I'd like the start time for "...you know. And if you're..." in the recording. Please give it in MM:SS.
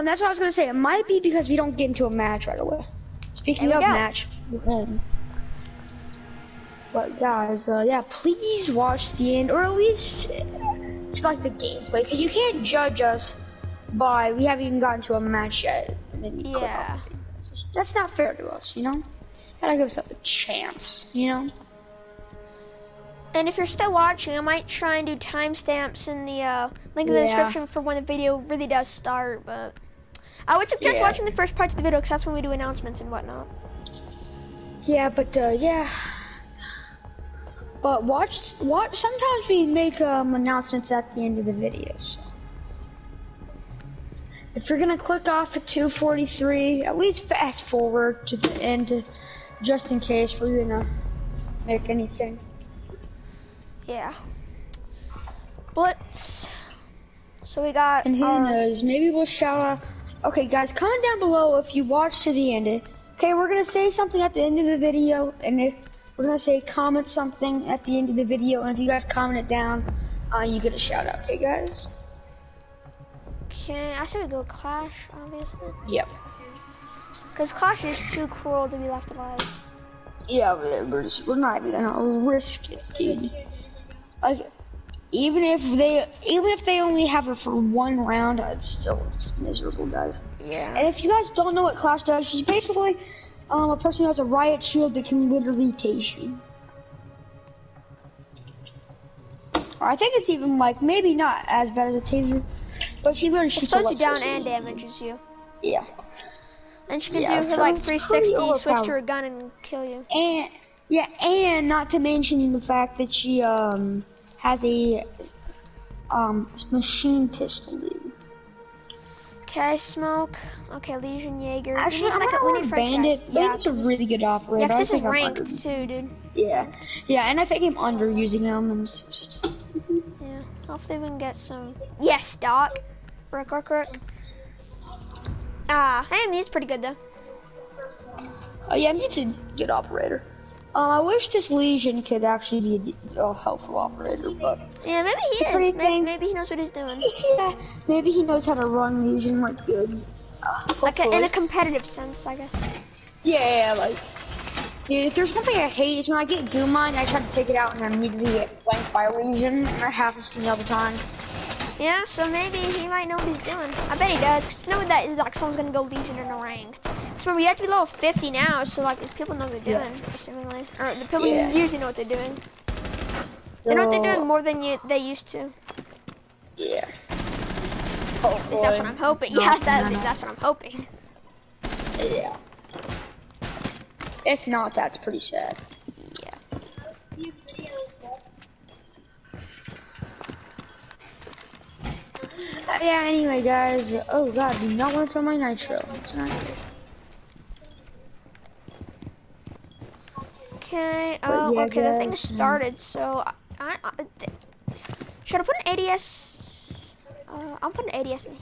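00:21.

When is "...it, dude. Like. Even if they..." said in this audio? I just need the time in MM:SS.
01:22.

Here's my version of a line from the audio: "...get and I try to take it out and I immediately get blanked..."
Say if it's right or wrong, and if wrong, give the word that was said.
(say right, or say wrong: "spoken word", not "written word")
right.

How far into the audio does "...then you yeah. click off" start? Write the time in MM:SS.
00:16.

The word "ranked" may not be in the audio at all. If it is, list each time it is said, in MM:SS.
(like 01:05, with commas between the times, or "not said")
02:05, 02:46.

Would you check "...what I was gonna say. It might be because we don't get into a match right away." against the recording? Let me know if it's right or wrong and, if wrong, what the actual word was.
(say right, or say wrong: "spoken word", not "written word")
right.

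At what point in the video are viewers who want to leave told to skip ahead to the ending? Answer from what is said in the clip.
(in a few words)
2:43.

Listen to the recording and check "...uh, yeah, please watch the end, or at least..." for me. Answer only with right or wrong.
right.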